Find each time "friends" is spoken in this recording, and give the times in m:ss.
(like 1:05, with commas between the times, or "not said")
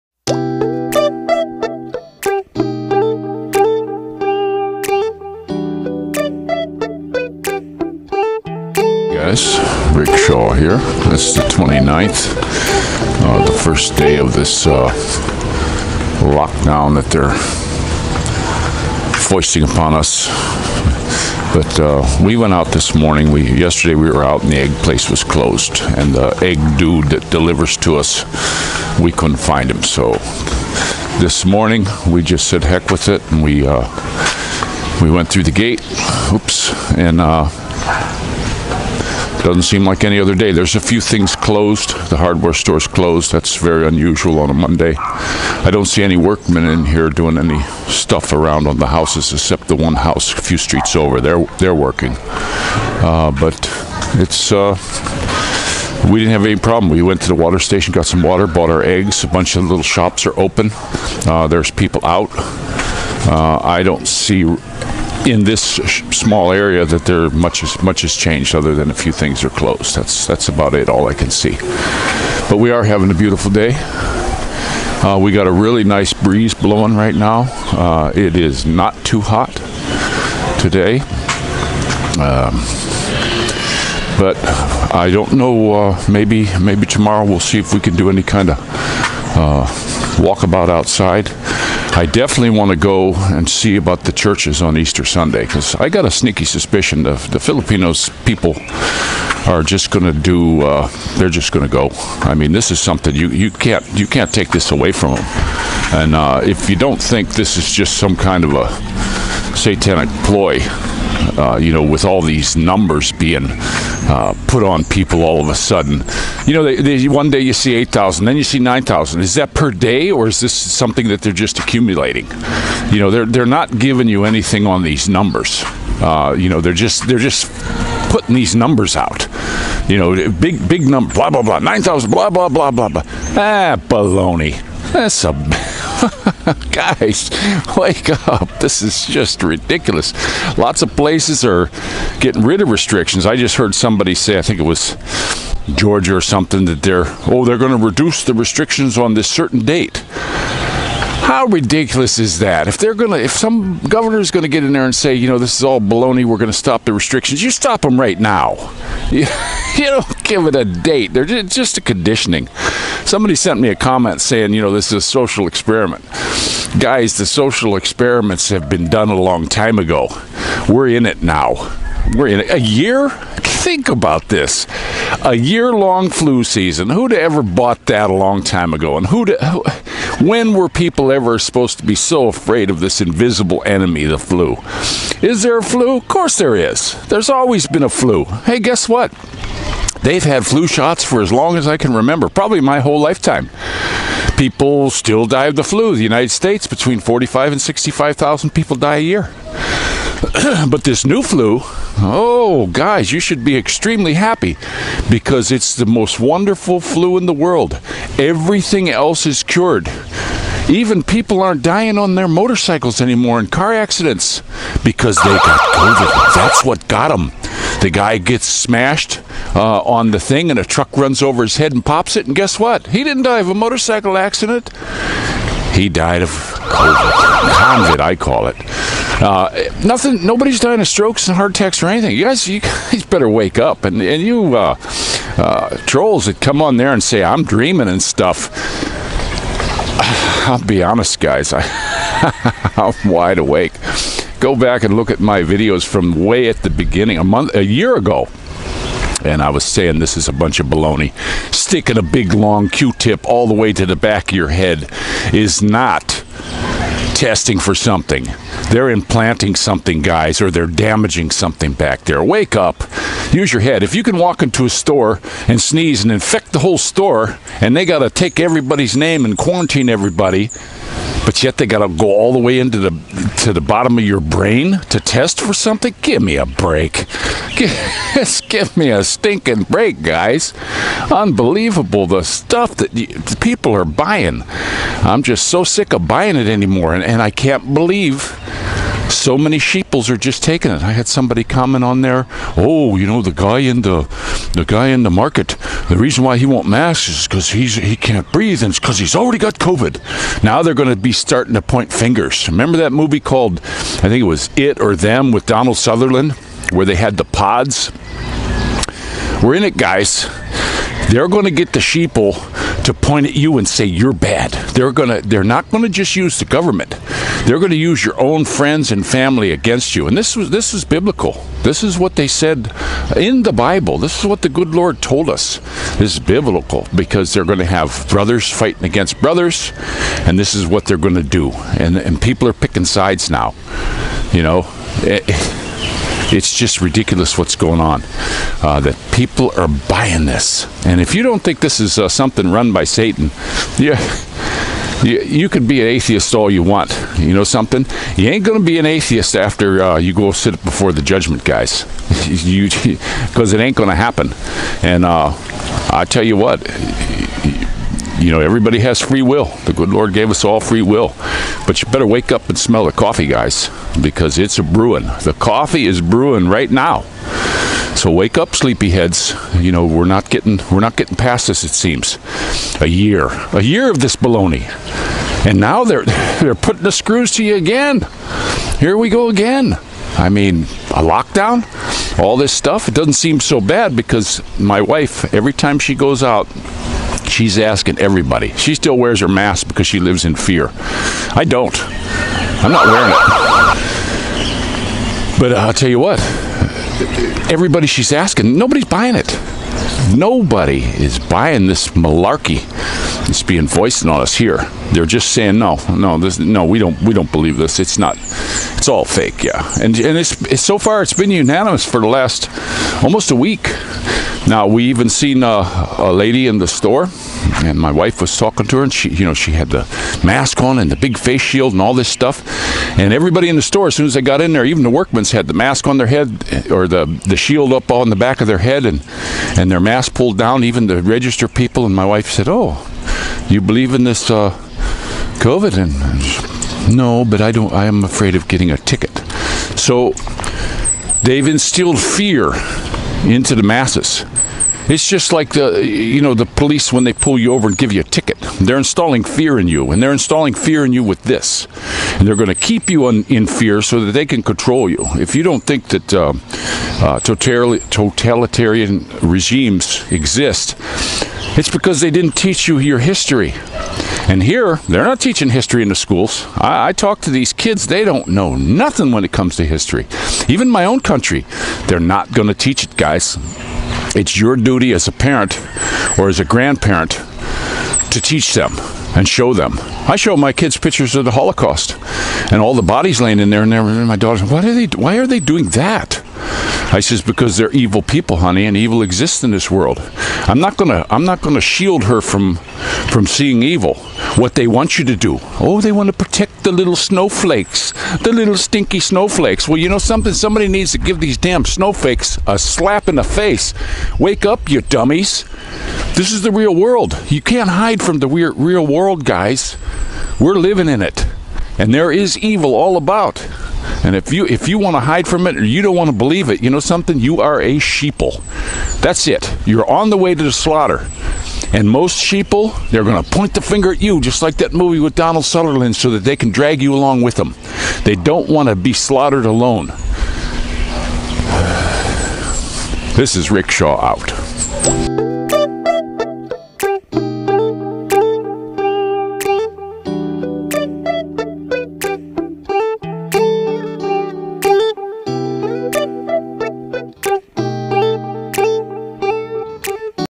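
5:18.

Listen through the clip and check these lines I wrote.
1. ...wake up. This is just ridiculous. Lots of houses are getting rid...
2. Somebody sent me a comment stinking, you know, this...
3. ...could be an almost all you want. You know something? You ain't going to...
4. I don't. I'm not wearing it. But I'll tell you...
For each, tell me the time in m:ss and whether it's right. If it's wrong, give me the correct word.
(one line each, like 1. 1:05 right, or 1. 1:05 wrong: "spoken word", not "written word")
1. 2:17 wrong: "places", not "houses"
2. 2:43 wrong: "saying", not "stinking"
3. 5:45 wrong: "atheist", not "almost"
4. 6:30 right.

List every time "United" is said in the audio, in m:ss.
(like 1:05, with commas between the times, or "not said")
3:16.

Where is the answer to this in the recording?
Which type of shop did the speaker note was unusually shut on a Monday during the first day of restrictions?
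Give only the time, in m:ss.
0:42.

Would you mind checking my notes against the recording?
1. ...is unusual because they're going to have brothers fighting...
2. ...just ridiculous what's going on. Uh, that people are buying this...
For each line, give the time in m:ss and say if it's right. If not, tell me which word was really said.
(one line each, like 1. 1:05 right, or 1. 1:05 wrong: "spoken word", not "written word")
1. 5:26 wrong: "biblical", not "unusual"
2. 5:36 right.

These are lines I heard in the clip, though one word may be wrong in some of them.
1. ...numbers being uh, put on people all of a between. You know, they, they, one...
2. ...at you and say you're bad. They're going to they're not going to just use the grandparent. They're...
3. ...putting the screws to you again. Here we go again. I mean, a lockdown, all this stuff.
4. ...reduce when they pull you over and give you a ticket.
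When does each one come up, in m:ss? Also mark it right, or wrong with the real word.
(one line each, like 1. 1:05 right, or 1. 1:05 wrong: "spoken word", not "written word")
1. 1:52 wrong: "sudden", not "between"
2. 5:13 wrong: "government", not "grandparent"
3. 6:16 right
4. 7:26 wrong: "police", not "reduce".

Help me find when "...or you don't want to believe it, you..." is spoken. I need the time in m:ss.
8:35.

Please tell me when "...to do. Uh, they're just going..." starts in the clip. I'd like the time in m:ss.
1:40.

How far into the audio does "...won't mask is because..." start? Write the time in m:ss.
4:56.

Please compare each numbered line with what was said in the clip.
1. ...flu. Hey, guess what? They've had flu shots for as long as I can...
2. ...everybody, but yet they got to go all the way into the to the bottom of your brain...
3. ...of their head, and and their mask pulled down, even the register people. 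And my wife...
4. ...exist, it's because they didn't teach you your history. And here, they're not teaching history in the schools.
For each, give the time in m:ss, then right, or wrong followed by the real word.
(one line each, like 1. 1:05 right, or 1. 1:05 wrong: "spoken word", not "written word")
1. 3:07 right
2. 4:29 right
3. 7:08 right
4. 7:40 right.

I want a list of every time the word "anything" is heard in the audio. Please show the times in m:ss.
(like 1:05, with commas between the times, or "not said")
2:04, 3:51.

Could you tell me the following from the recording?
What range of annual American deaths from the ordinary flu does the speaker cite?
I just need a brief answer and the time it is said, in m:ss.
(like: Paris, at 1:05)
45,000 to 65,000, at 3:16.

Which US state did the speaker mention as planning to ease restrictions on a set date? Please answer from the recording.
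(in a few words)
Georgia.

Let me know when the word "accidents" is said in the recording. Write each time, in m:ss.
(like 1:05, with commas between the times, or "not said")
3:33, 3:44.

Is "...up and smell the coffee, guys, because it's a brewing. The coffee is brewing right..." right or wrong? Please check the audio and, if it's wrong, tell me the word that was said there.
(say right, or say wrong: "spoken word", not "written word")
right.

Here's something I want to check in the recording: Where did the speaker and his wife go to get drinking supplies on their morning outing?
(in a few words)
water station.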